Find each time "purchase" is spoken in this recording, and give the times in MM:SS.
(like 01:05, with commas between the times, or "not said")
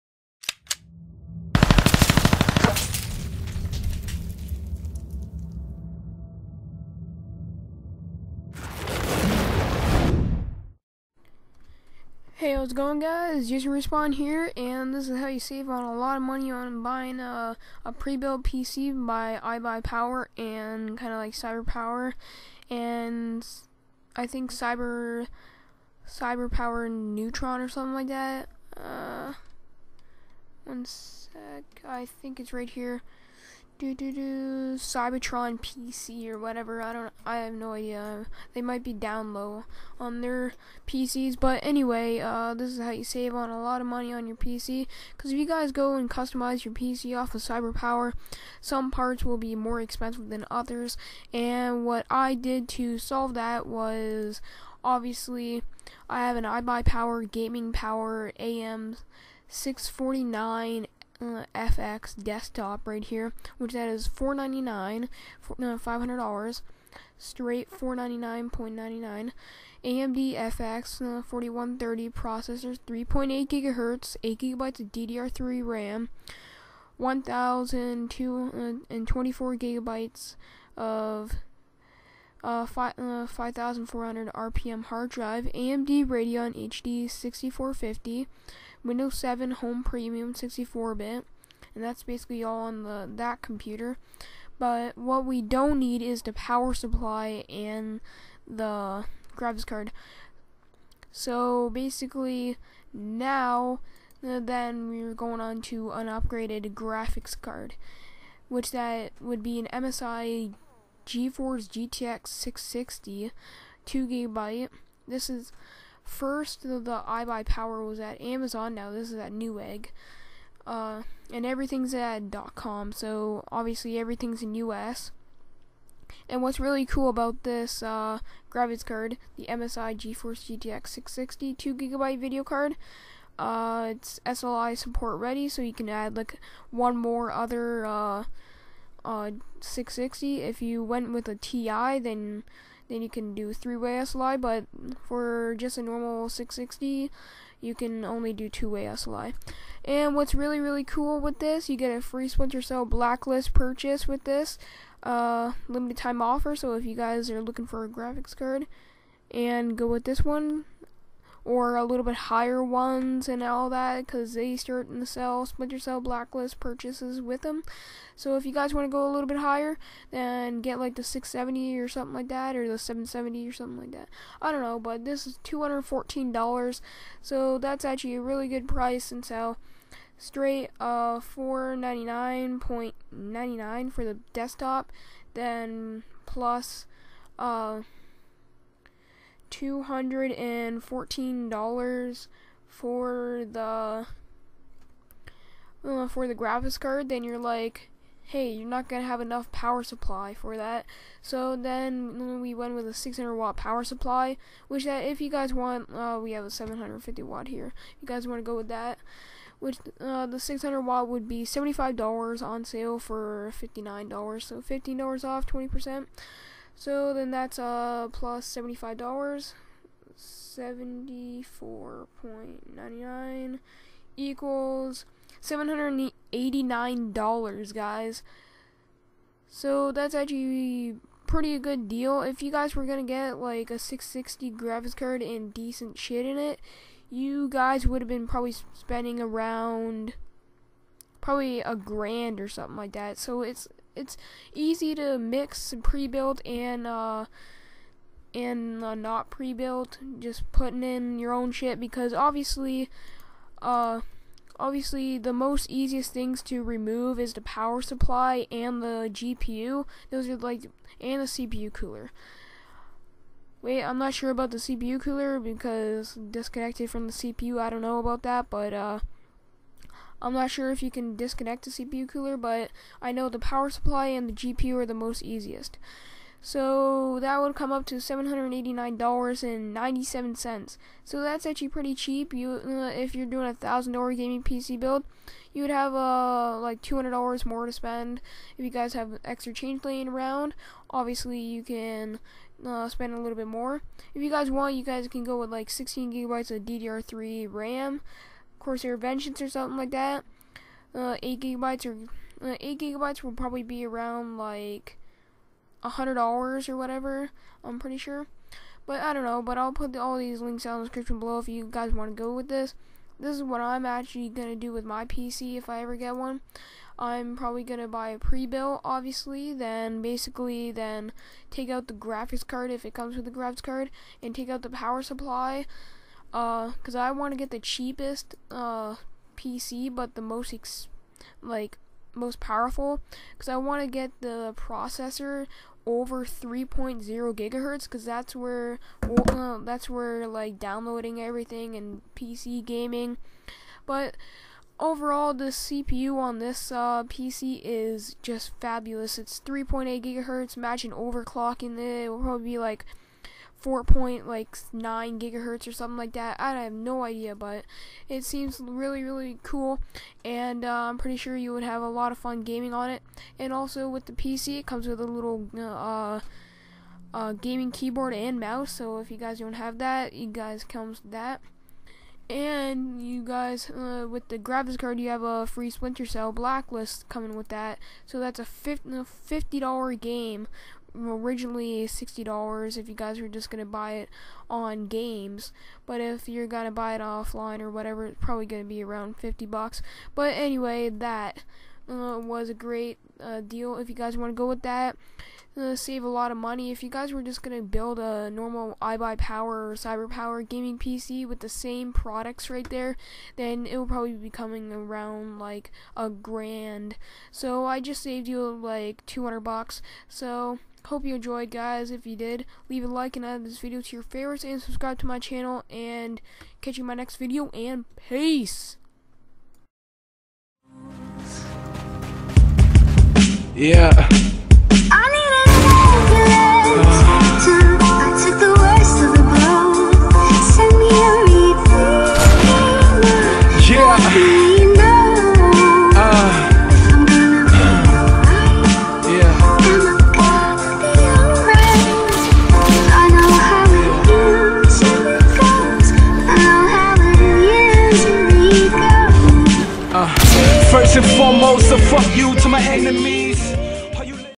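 02:33, 02:46.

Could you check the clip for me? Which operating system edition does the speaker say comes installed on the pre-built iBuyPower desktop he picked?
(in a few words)
Windows 7 Home Premium 64-bit.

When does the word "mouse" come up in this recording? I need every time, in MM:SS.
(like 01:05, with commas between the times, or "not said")
06:08.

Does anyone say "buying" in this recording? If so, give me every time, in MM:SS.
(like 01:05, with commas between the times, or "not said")
00:16.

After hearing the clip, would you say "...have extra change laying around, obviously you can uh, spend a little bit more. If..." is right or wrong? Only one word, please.
right.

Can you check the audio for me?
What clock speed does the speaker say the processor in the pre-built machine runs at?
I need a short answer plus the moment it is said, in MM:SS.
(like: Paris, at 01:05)
3.8 gigahertz, at 05:49.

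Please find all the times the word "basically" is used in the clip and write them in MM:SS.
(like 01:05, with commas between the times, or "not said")
01:32, 01:41, 05:20.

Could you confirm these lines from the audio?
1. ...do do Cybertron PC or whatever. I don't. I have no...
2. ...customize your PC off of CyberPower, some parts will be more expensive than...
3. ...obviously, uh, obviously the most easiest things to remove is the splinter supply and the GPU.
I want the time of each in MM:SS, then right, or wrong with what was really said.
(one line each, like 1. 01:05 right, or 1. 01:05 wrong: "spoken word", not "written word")
1. 00:33 right
2. 00:46 right
3. 04:12 wrong: "power", not "splinter".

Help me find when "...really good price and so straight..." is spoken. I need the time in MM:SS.
02:58.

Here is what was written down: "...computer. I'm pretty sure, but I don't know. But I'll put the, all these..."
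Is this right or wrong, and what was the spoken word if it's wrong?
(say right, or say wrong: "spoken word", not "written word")
wrong: "whatever", not "computer".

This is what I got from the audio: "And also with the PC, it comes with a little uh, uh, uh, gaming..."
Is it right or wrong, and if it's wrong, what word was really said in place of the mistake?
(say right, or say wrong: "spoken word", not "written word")
right.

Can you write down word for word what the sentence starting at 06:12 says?
And you guys, uh, with the graphics card, you have a free Splinter Cell Blacklist coming with that.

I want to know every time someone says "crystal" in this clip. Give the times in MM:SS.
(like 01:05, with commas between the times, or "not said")
not said.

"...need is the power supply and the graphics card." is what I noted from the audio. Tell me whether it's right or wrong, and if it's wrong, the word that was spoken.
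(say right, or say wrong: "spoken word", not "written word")
right.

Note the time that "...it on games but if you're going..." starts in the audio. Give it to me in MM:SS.
06:23.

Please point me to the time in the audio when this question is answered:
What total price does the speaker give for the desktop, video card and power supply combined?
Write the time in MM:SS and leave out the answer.
04:37.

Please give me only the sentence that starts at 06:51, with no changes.
If you did, leave a like and add this video to your favorites and subscribe to my channel.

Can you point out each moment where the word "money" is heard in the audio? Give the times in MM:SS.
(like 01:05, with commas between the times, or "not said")
00:16, 00:43, 06:36.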